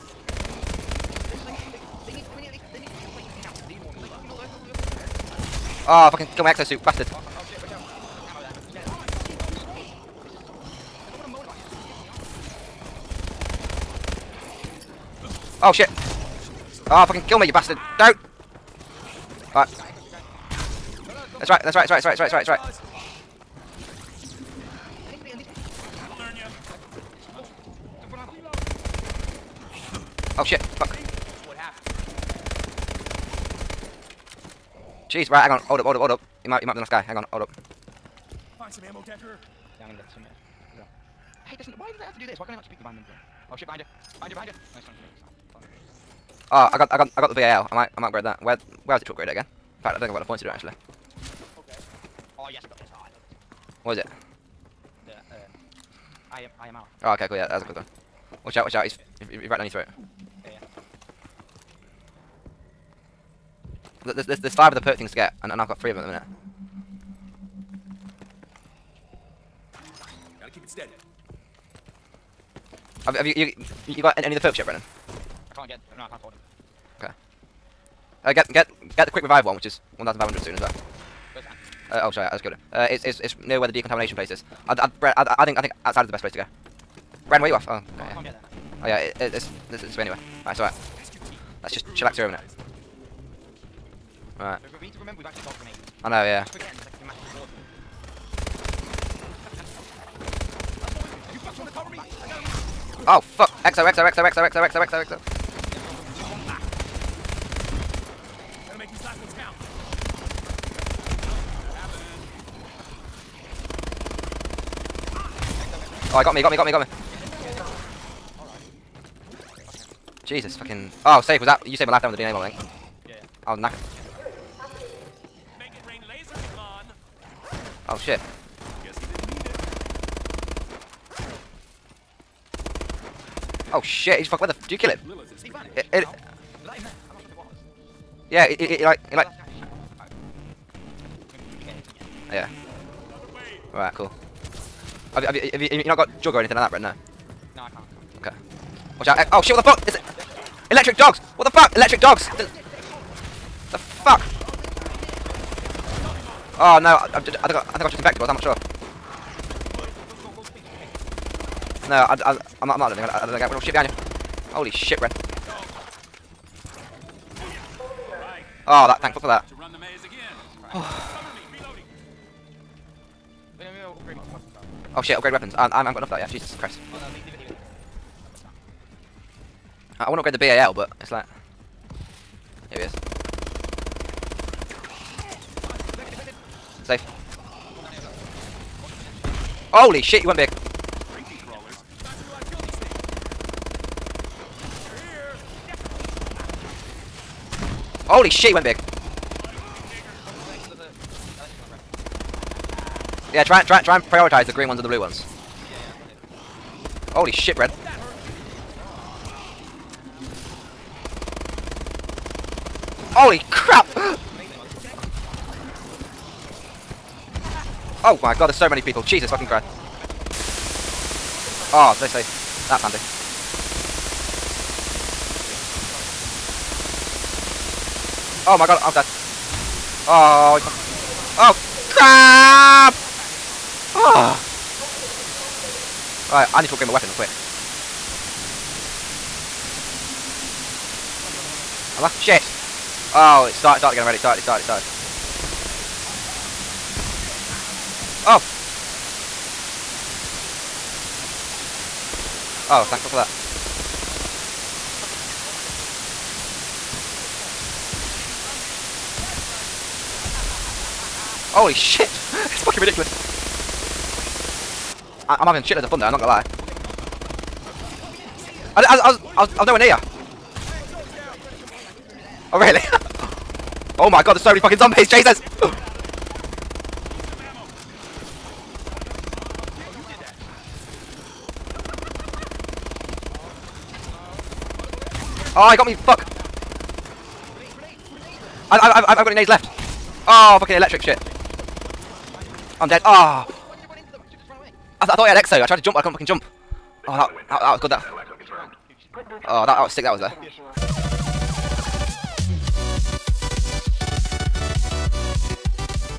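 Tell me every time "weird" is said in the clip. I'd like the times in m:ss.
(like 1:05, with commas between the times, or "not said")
not said.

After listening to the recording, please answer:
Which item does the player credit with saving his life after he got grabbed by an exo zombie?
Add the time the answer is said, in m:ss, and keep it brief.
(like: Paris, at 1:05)
DNA bomb, at 2:02.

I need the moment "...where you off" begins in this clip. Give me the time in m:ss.
1:27.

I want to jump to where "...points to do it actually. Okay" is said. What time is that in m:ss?
0:50.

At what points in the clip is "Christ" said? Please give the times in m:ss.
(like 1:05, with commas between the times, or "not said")
2:56, 3:39.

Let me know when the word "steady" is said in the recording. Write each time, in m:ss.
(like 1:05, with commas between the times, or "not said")
1:10.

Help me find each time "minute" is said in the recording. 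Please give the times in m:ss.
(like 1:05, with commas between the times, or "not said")
1:06, 1:32.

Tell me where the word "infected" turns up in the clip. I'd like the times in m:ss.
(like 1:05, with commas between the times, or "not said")
2:37.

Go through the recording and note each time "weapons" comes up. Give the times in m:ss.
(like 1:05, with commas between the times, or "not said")
2:55, 3:56.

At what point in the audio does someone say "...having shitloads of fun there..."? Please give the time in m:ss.
4:25.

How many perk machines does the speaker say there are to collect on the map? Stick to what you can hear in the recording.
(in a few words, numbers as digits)
5.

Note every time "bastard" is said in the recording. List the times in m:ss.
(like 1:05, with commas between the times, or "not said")
0:06, 0:17.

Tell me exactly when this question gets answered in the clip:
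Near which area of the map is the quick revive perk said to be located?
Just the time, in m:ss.
1:23.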